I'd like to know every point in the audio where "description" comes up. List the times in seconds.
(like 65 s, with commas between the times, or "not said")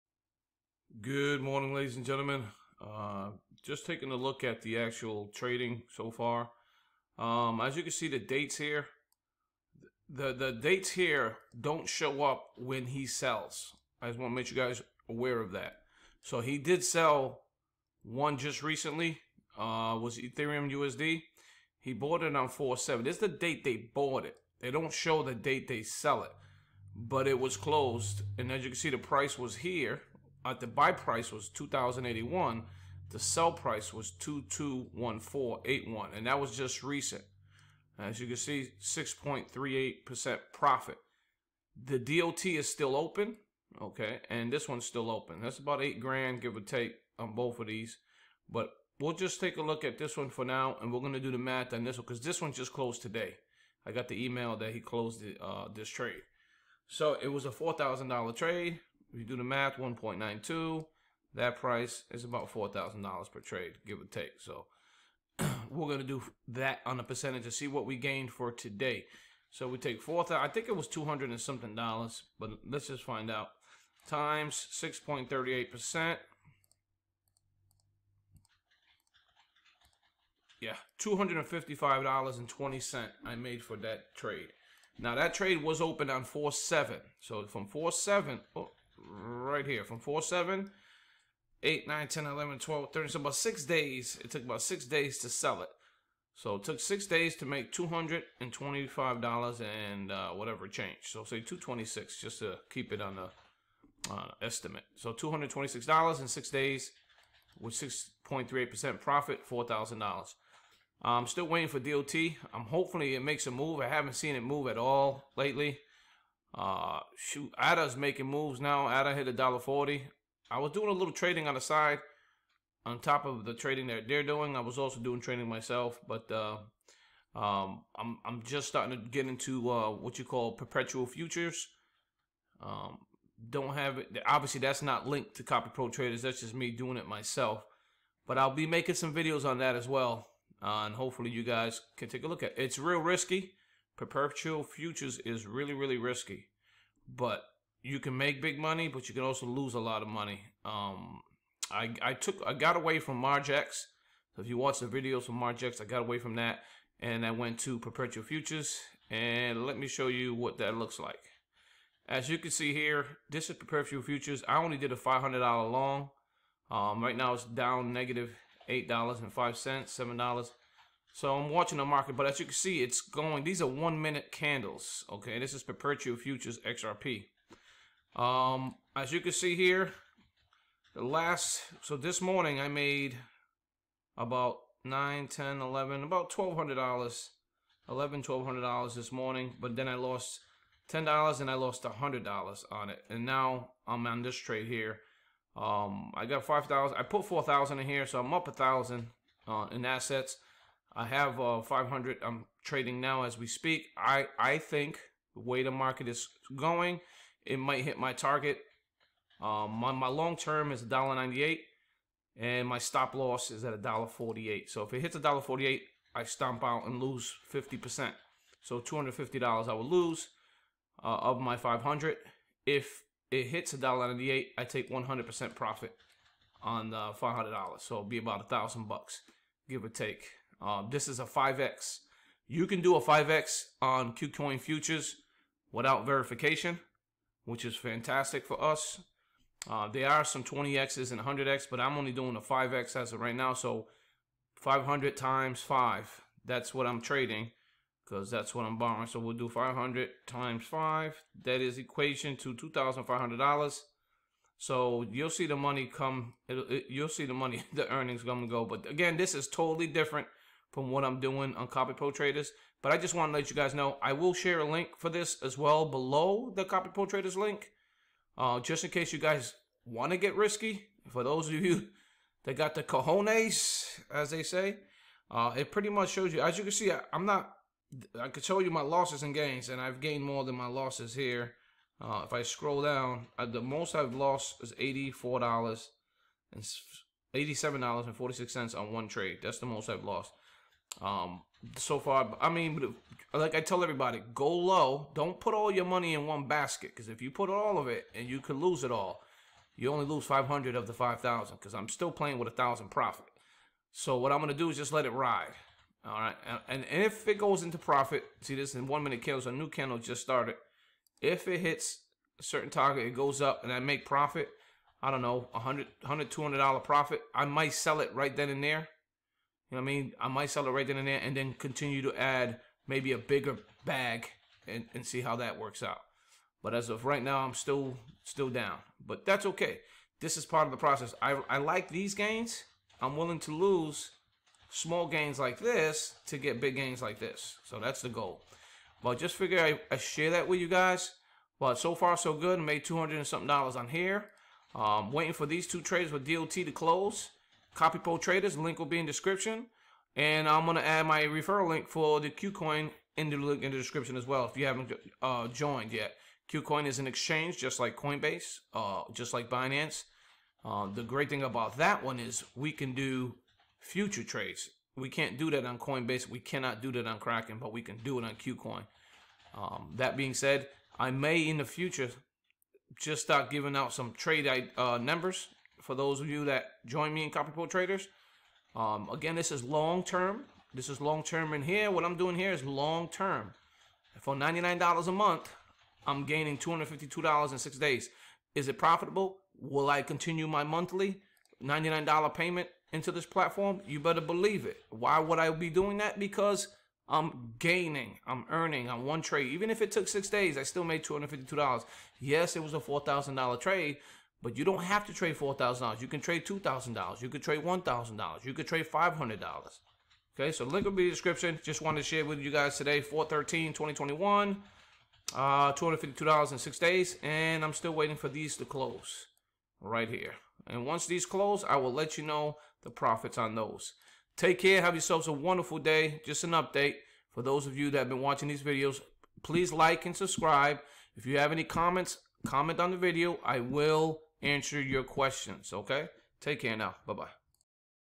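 349 s, 353 s, 411 s.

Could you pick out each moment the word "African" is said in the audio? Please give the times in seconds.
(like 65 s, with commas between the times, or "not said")
not said.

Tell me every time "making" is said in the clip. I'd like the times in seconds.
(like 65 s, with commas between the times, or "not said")
117 s, 138 s.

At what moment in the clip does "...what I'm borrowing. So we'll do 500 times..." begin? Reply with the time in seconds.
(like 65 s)
248 s.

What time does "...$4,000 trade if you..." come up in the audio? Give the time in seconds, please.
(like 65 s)
57 s.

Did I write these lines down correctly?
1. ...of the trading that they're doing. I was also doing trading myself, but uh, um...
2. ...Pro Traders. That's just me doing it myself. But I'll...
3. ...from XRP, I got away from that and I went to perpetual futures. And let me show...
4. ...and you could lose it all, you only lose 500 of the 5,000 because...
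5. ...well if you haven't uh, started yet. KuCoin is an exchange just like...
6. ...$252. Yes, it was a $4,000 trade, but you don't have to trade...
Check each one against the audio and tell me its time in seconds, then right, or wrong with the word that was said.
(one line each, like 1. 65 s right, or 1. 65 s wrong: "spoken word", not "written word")
1. 123 s right
2. 135 s right
3. 155 s wrong: "Margex", not "XRP"
4. 298 s right
5. 354 s wrong: "joined", not "started"
6. 401 s right.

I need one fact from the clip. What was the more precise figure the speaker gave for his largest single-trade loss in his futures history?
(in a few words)
$87.46.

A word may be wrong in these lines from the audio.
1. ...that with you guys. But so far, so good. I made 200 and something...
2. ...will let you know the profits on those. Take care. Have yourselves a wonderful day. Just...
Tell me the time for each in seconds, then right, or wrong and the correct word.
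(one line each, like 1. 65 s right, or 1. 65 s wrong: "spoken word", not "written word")
1. 340 s right
2. 421 s right.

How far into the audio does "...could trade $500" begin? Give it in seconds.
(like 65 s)
408 s.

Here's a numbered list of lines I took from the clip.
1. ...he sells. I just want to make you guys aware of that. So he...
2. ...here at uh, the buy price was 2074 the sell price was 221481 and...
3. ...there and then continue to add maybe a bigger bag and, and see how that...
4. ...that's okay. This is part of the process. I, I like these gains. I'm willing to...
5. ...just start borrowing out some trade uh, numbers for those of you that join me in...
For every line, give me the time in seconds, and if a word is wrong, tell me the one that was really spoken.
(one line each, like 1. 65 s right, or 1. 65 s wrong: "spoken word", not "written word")
1. 12 s right
2. 29 s wrong: "2081", not "2074"
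3. 321 s right
4. 329 s right
5. 372 s wrong: "giving", not "borrowing".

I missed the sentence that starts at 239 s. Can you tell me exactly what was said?
Uh, there are some 20Xs and 100X, but I'm only doing a 5X as of right now.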